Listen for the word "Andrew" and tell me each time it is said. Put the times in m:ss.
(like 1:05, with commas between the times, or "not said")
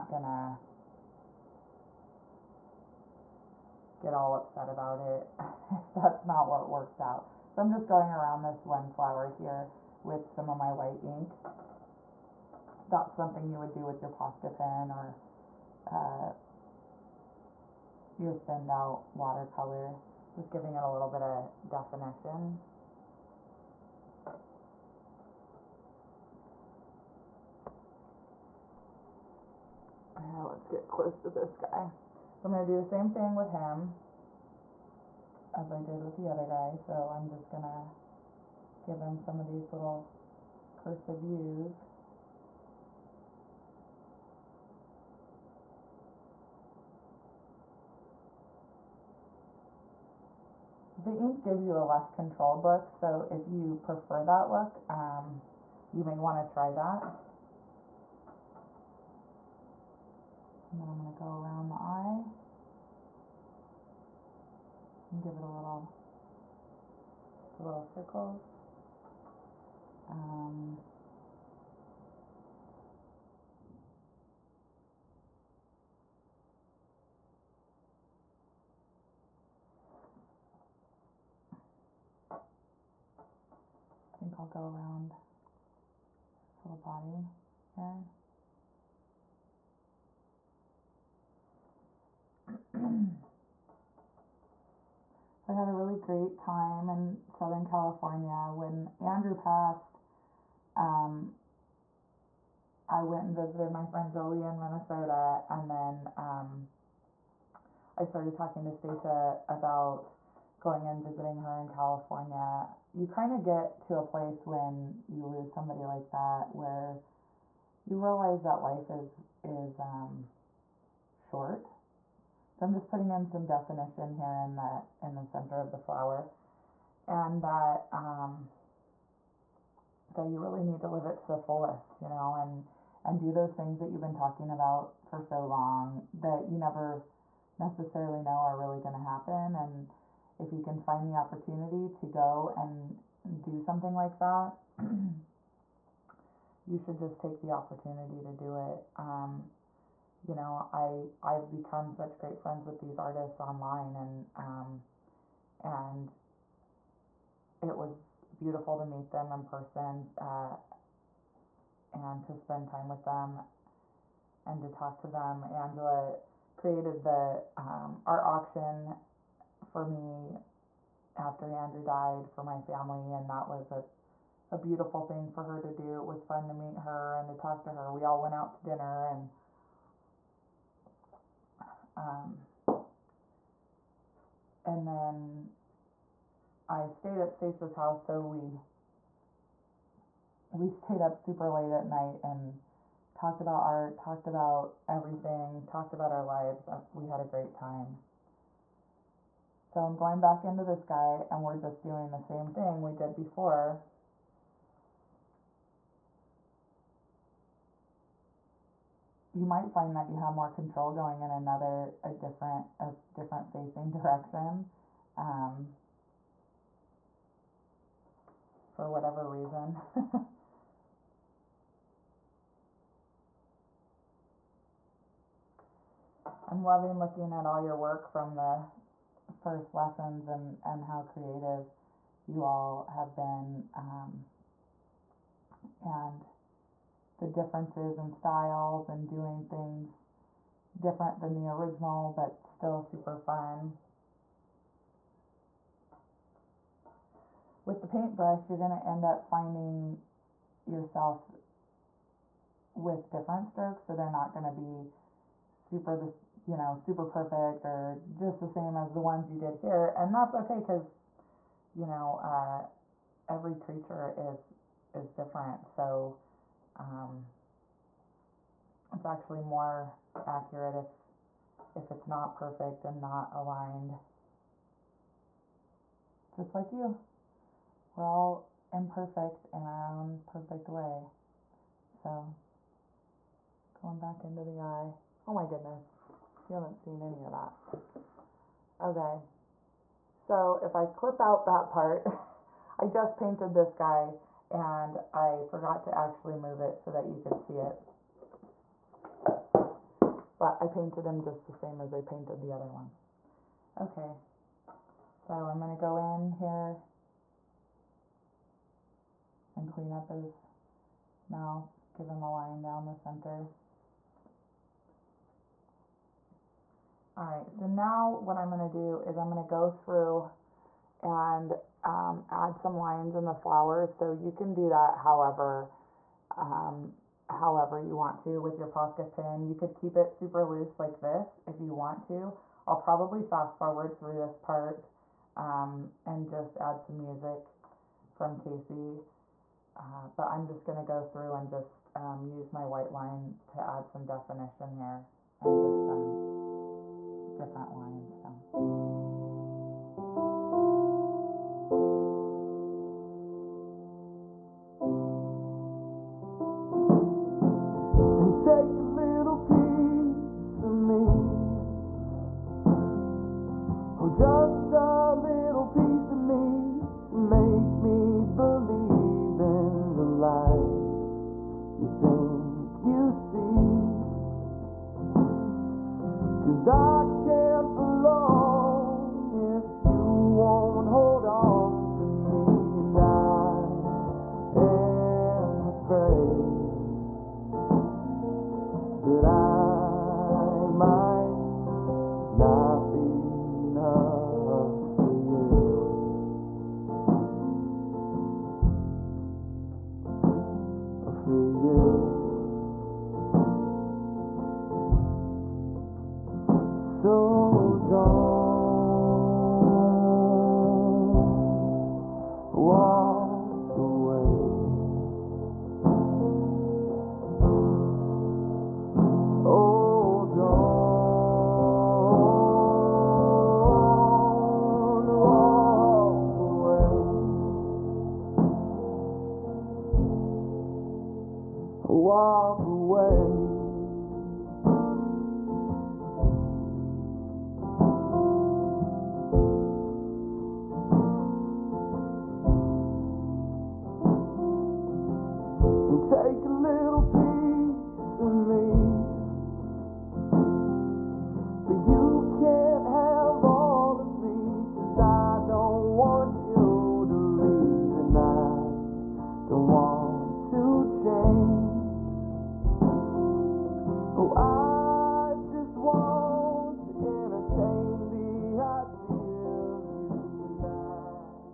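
1:38, 2:51.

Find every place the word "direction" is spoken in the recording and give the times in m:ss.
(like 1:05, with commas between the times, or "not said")
3:33.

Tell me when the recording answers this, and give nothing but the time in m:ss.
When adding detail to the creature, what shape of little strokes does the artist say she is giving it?
0:40.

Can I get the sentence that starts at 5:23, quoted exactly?
So you can do that however, um, however you want to with your Posca pin.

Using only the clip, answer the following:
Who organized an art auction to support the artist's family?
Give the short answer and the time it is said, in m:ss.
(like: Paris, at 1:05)
Angela, at 2:45.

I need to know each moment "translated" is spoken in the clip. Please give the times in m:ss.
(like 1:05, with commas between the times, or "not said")
not said.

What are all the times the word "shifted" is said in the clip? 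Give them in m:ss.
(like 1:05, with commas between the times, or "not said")
not said.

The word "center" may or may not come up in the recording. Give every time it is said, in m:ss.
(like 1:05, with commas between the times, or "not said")
2:05, 5:12.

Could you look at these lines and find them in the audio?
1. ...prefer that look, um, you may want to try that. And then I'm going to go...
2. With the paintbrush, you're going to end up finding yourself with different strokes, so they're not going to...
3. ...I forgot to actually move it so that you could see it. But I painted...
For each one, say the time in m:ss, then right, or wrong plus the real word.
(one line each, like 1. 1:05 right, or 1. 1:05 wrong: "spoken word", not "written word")
1. 0:53 right
2. 4:07 right
3. 4:55 right.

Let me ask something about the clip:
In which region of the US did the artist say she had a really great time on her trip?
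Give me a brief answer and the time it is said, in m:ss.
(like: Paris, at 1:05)
Southern California, at 1:37.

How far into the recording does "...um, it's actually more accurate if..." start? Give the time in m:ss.
4:26.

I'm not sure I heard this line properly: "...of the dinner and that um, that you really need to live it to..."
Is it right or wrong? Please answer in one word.
wrong.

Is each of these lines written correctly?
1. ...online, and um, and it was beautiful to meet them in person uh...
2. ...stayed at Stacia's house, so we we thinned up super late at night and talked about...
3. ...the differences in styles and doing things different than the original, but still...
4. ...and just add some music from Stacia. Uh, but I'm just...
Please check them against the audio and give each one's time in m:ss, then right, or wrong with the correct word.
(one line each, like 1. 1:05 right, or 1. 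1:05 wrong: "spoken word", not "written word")
1. 2:33 right
2. 3:06 wrong: "stayed", not "thinned"
3. 3:57 right
4. 5:36 wrong: "Casey", not "Stacia".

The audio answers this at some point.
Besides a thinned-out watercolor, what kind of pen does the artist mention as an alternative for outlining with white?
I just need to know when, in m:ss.
0:14.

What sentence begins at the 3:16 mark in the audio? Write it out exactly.
Uh, we had a great time.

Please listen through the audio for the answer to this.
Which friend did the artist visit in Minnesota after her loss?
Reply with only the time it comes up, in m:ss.
1:44.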